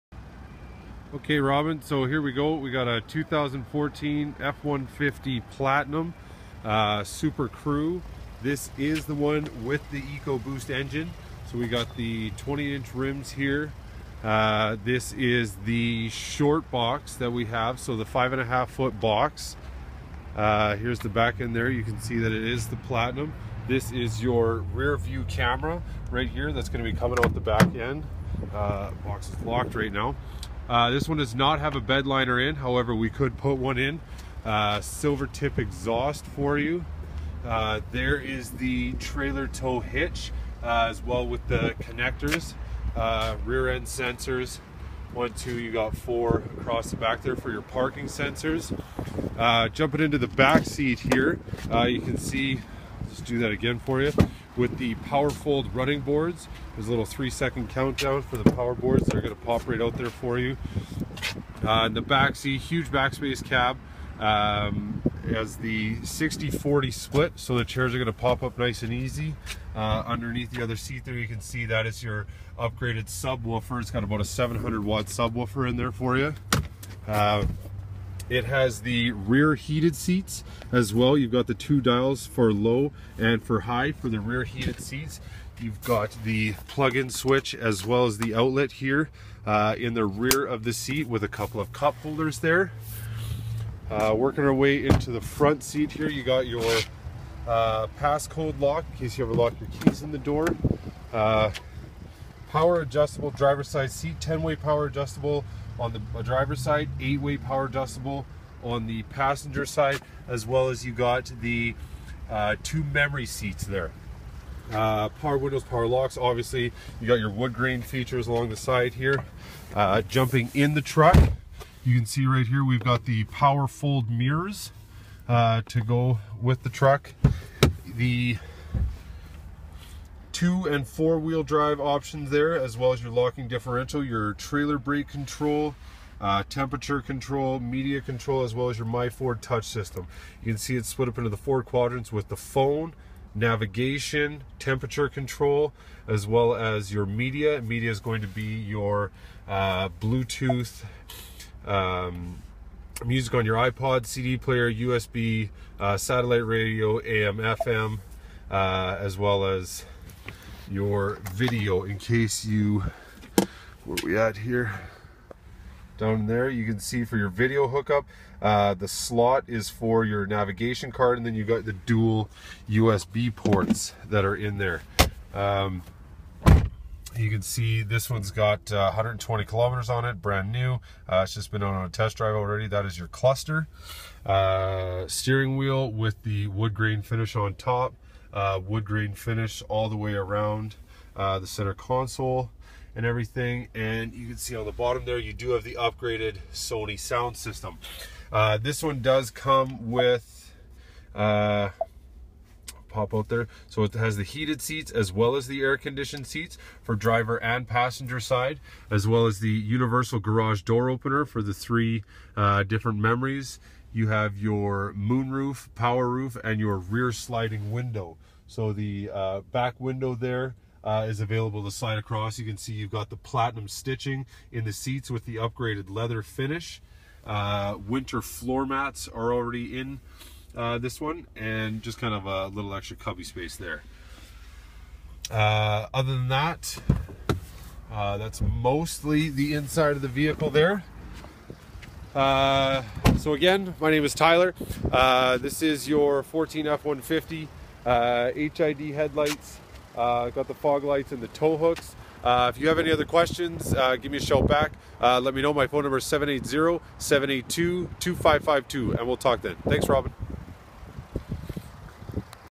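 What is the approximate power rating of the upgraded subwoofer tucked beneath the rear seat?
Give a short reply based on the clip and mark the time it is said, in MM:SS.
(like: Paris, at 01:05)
700 watts, at 01:14.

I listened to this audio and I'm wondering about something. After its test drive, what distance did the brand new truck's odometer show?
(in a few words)
120 kilometers.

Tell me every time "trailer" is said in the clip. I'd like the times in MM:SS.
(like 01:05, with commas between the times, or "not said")
00:38, 02:14.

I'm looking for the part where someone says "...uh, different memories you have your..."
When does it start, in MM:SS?
03:32.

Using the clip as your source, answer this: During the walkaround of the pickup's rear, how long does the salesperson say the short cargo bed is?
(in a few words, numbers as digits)
5.5 feet.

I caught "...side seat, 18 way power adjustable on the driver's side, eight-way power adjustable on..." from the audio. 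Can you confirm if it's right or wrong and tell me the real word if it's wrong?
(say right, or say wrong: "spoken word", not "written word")
wrong: "10", not "18".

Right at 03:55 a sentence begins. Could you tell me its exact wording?
Uh, other than that, uh, that's mostly the inside of the vehicle there.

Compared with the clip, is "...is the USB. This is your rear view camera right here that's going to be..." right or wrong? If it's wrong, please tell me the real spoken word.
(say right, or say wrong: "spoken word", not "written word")
wrong: "Platinum", not "USB".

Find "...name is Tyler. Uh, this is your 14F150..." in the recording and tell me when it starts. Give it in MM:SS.
04:03.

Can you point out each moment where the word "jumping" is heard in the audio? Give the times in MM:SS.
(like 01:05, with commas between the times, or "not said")
00:49, 02:00.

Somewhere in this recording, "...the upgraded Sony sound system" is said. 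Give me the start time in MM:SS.
03:15.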